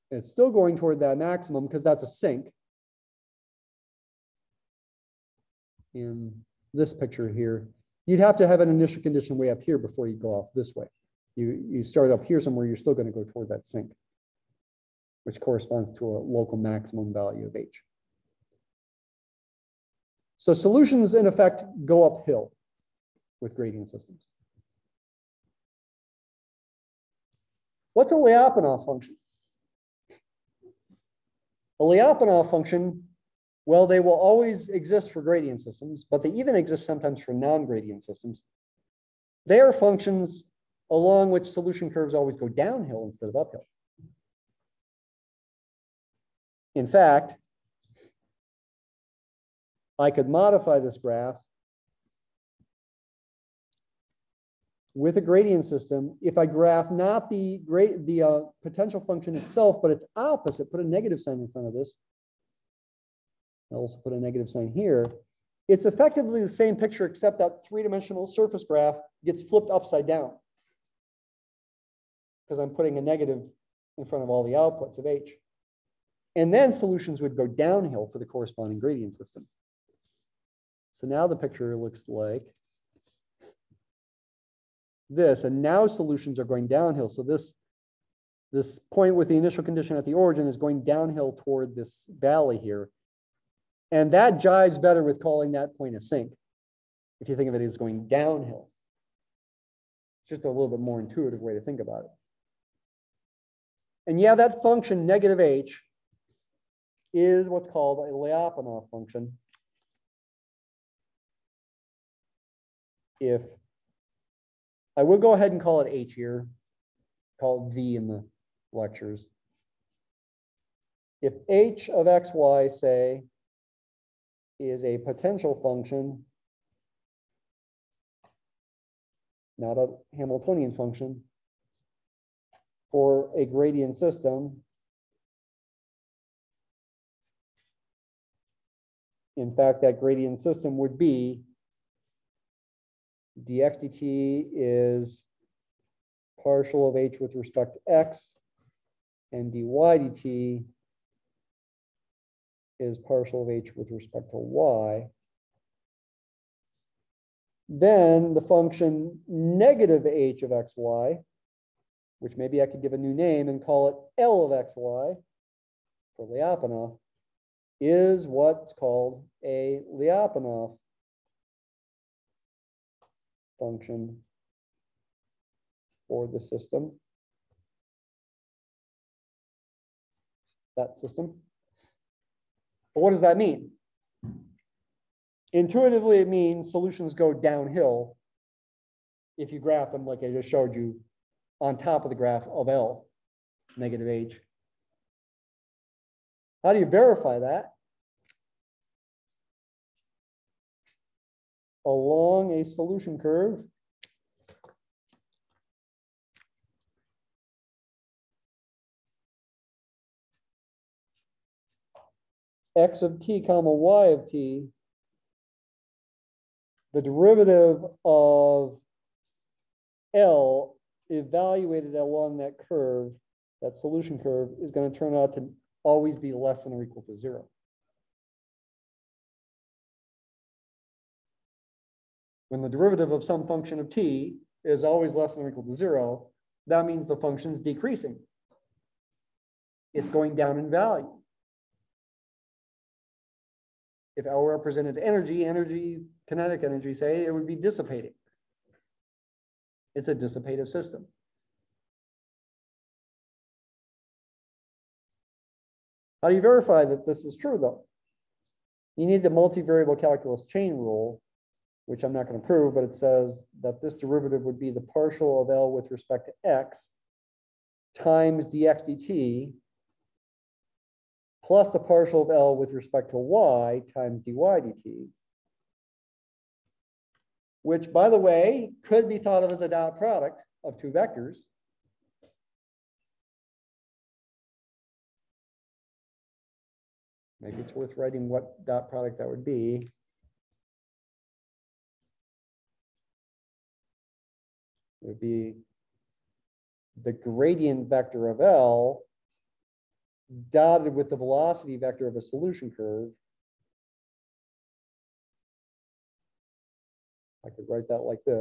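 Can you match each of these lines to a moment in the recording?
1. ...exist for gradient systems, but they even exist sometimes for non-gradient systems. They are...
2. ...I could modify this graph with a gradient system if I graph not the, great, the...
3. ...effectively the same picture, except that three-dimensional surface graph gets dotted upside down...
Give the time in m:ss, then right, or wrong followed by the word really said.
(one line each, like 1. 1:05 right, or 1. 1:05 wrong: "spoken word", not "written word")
1. 0:34 right
2. 0:49 right
3. 1:05 wrong: "flipped", not "dotted".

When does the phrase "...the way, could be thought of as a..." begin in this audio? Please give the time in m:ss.
4:38.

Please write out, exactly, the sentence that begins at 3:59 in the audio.
It's going down in value if L represented energy, energy, kinetic energy, say, it would be dissipating.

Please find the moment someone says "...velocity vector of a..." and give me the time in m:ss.
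5:01.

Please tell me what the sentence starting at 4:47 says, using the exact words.
Maybe it's worth writing what dot product that would be.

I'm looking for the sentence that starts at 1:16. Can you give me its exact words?
And then solutions would go downhill for the corresponding gradient system.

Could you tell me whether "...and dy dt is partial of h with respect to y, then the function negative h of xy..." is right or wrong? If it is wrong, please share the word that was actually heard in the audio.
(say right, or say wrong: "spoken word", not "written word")
right.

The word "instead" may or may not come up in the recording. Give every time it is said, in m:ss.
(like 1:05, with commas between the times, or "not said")
0:43.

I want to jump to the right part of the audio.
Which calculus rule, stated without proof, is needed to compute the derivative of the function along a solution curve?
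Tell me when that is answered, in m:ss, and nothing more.
4:19.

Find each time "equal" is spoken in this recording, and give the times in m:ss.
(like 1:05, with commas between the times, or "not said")
3:46, 3:55.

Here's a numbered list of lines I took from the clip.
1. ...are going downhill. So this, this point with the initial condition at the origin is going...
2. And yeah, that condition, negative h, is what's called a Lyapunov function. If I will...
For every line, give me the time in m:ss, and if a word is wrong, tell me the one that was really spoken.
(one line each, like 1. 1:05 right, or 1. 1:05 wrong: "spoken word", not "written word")
1. 1:26 right
2. 1:44 wrong: "function", not "condition".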